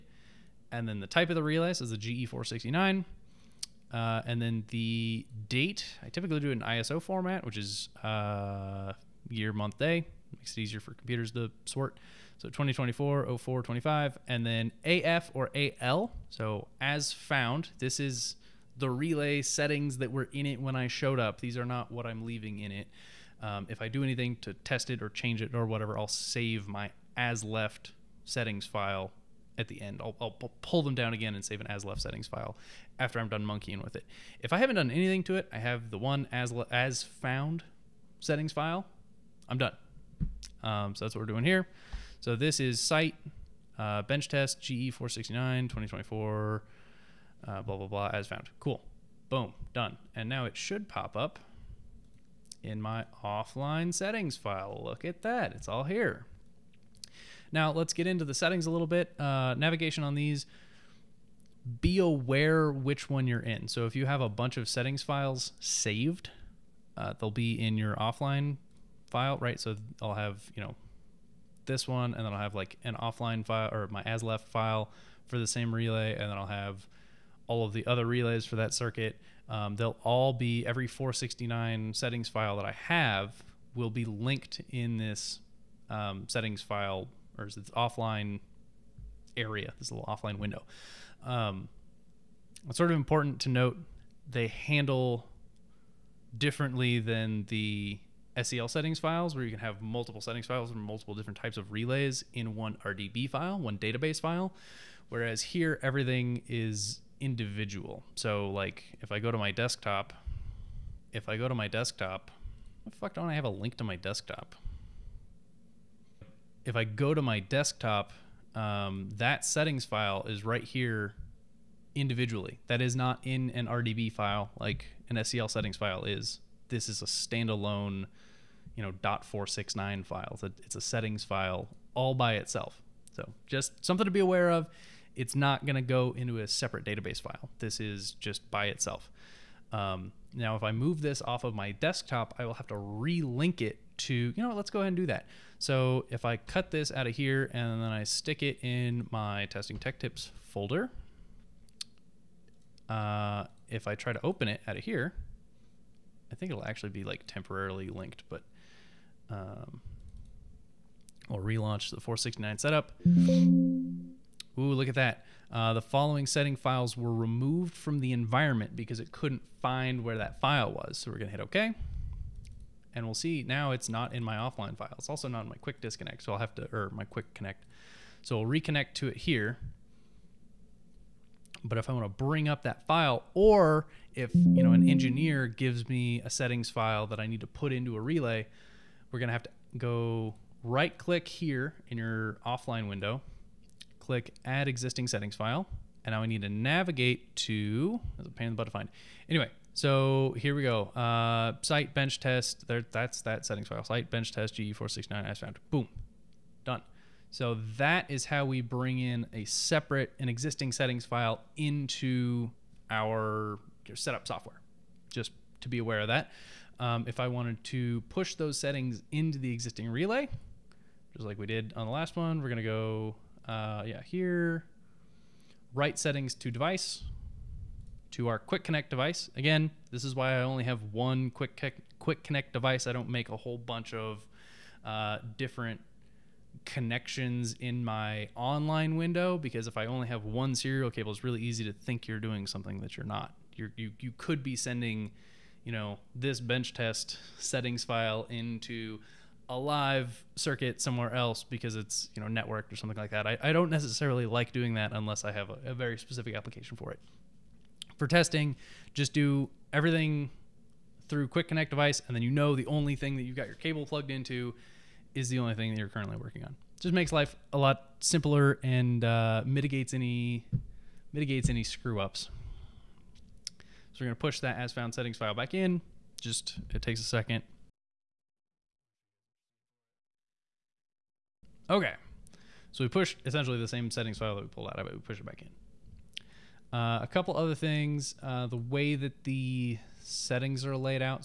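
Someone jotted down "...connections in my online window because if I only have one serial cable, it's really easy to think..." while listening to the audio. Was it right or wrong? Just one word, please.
right.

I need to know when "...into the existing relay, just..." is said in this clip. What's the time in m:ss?
3:39.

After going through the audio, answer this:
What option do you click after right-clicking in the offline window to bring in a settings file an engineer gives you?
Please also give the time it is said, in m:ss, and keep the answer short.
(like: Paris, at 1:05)
add existing settings file, at 3:14.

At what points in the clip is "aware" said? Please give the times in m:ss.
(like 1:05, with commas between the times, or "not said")
1:01, 2:14, 3:35.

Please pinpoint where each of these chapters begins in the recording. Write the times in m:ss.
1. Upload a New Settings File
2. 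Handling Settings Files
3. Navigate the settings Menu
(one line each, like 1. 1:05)
1. 3:27
2. 0:55
3. 4:23.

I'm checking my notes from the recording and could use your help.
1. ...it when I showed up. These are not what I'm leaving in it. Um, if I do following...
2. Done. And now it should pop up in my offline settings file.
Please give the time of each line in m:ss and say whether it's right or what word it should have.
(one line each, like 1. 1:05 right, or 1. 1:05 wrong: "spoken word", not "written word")
1. 0:20 wrong: "anything", not "following"
2. 0:49 right.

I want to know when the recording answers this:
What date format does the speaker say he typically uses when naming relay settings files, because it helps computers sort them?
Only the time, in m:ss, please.
0:06.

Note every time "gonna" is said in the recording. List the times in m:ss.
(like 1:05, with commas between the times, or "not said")
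3:09, 3:42, 4:34.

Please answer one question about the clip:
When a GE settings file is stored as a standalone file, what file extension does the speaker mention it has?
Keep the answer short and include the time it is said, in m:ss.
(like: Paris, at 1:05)
.469, at 2:09.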